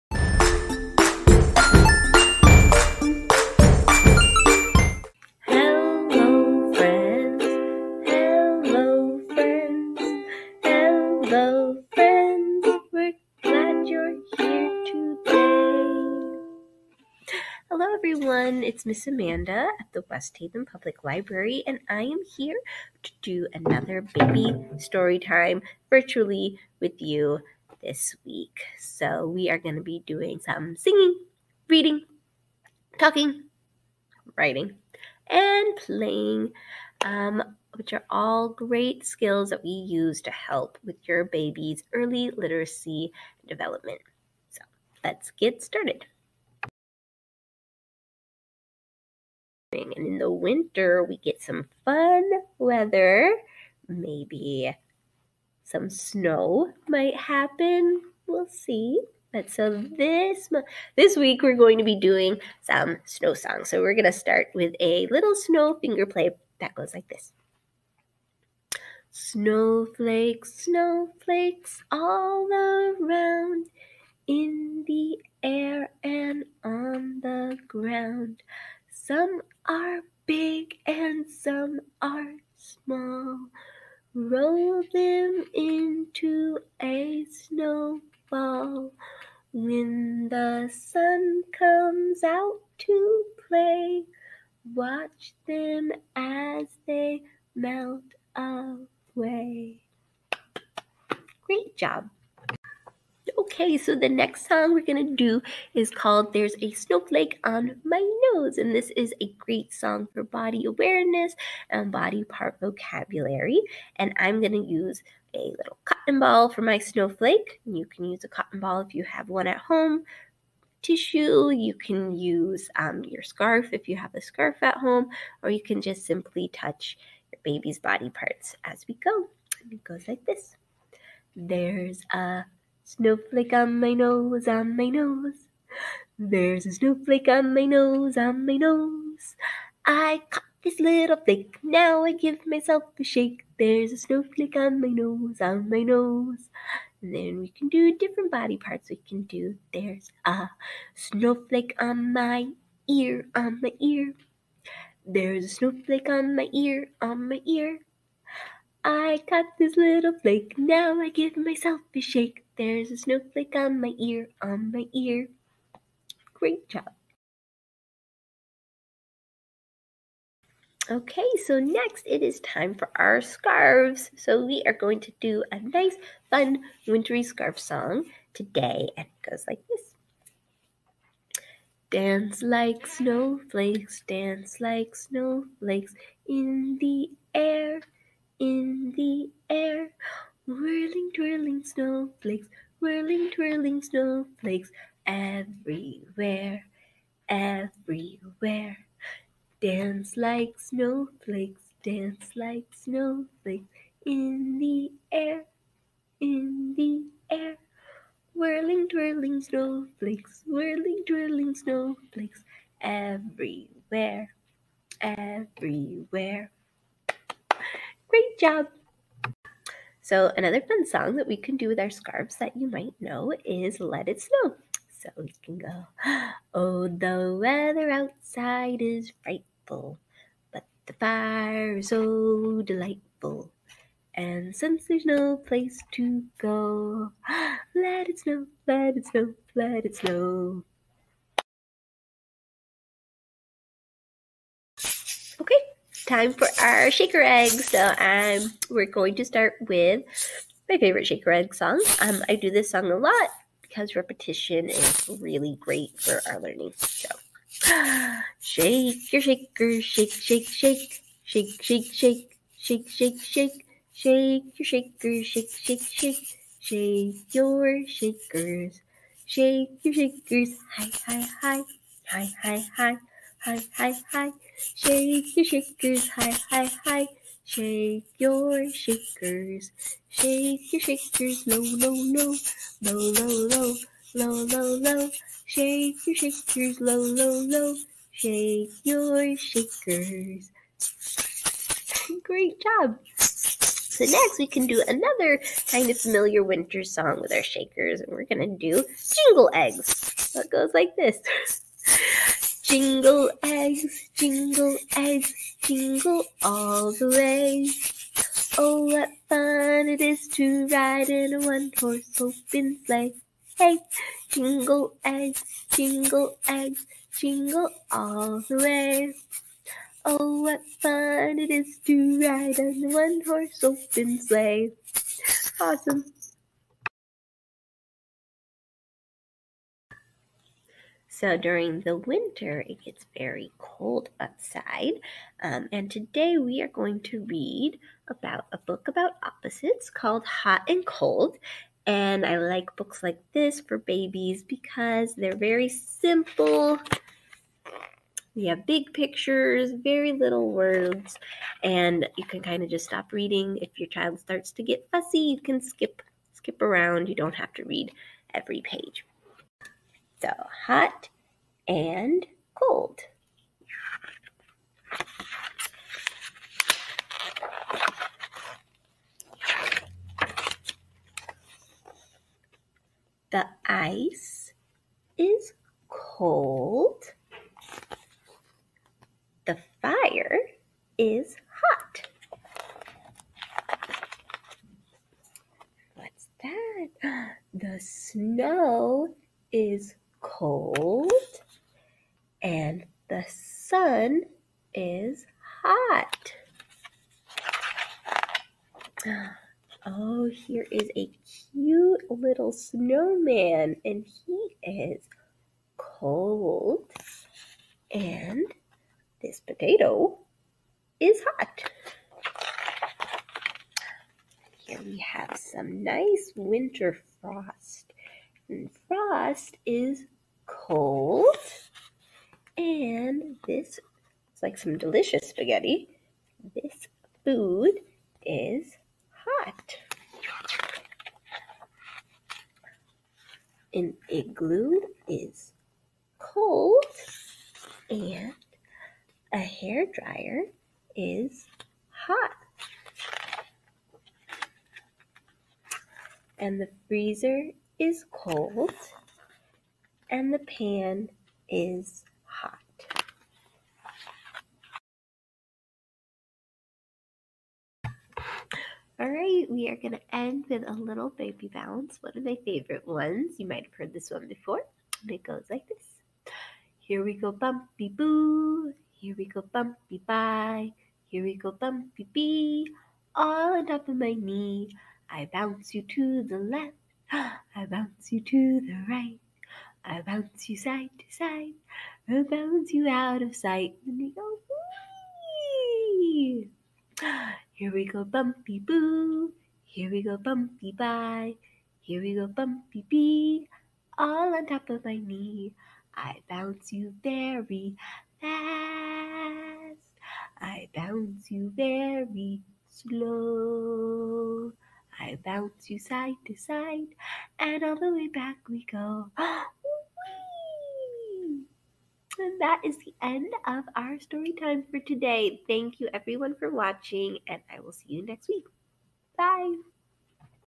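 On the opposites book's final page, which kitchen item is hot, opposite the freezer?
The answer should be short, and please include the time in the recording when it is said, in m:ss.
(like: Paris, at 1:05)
pan, at 7:30.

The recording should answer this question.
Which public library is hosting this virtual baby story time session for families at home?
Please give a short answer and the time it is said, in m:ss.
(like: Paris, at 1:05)
West Haven Public Library, at 0:20.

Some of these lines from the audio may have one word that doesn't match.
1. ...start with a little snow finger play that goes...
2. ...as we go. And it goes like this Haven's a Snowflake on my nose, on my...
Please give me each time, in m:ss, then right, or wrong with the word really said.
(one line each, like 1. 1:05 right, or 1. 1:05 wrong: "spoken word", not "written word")
1. 1:04 right
2. 2:08 wrong: "There", not "Haven".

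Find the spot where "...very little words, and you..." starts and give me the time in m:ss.
5:49.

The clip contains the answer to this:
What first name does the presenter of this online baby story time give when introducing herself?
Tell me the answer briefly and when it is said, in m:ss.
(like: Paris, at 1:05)
Amanda, at 0:19.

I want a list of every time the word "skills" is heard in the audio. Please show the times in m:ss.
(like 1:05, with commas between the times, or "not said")
0:39.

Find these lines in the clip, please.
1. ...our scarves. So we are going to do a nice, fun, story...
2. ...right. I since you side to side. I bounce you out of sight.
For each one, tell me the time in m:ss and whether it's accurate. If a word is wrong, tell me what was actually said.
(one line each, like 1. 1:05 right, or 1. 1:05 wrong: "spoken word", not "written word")
1. 2:52 wrong: "wintry", not "story"
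2. 7:58 wrong: "bounce", not "since".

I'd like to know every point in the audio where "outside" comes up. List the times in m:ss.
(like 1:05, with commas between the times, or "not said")
3:47, 5:34.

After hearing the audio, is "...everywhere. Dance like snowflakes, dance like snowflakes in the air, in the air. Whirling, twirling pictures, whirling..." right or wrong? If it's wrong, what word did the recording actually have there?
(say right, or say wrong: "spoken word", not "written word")
wrong: "snowflakes", not "pictures".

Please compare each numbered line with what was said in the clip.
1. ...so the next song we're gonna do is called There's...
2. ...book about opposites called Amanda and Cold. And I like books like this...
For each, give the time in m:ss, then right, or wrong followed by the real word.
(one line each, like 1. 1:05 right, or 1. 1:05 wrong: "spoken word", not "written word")
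1. 1:43 right
2. 5:38 wrong: "Hot", not "Amanda".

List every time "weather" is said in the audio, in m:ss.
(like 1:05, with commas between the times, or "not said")
0:52, 3:47.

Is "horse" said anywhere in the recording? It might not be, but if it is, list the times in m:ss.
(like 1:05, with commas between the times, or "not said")
5:11, 5:22.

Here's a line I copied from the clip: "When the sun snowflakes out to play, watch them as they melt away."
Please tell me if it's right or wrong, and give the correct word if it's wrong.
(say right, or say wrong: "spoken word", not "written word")
wrong: "comes", not "snowflakes".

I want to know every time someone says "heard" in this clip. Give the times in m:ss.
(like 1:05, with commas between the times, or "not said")
7:43.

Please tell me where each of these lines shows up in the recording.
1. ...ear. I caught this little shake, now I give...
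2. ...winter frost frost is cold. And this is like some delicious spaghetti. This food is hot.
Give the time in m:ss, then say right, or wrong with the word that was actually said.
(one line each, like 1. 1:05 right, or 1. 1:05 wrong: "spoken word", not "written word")
1. 2:37 wrong: "flake", not "shake"
2. 6:56 right.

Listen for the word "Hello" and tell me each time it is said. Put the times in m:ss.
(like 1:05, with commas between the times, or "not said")
0:17.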